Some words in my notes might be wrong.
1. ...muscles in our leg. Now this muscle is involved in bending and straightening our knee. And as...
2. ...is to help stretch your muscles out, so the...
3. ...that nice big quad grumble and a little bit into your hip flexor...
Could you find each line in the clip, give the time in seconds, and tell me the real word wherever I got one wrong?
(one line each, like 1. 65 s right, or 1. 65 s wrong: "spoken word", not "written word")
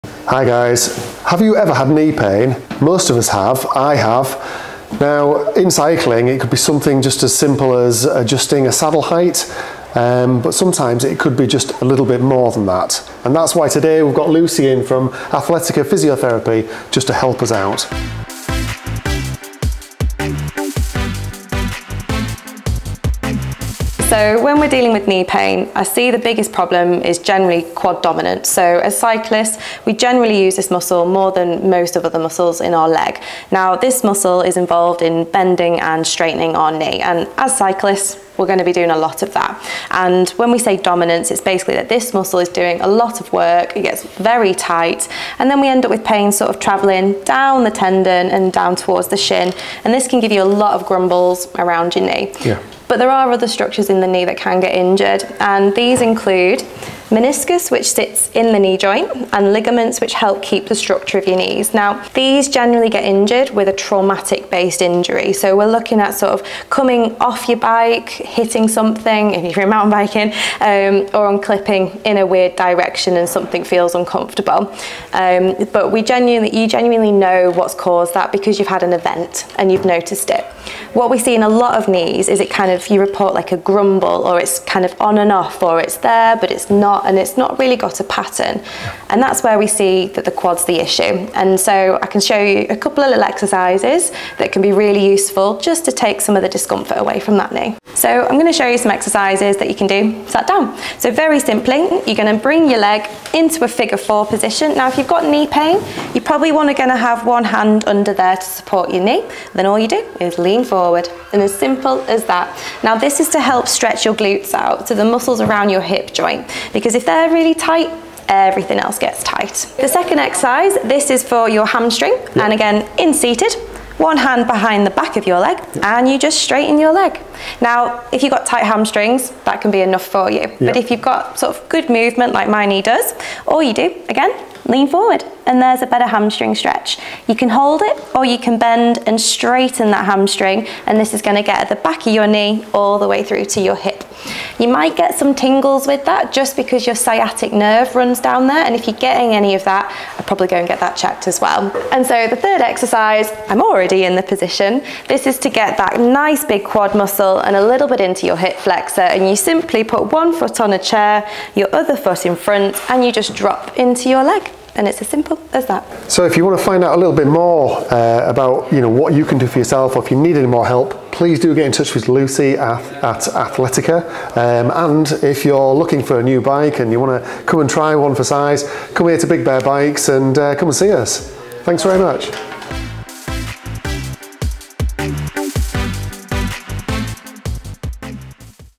1. 32 s right
2. 113 s wrong: "glutes", not "muscles"
3. 155 s wrong: "muscle", not "grumble".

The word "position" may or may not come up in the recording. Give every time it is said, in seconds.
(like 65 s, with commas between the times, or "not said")
104 s, 154 s.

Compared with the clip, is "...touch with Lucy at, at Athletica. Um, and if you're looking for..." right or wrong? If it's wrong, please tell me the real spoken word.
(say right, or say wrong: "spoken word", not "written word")
right.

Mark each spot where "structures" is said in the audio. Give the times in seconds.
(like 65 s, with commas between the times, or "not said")
53 s, 60 s.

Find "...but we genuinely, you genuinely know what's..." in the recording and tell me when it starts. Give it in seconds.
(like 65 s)
75 s.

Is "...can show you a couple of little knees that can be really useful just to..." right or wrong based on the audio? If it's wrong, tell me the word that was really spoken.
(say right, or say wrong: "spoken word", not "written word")
wrong: "exercises", not "knees".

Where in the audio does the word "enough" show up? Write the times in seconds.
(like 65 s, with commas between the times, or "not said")
129 s.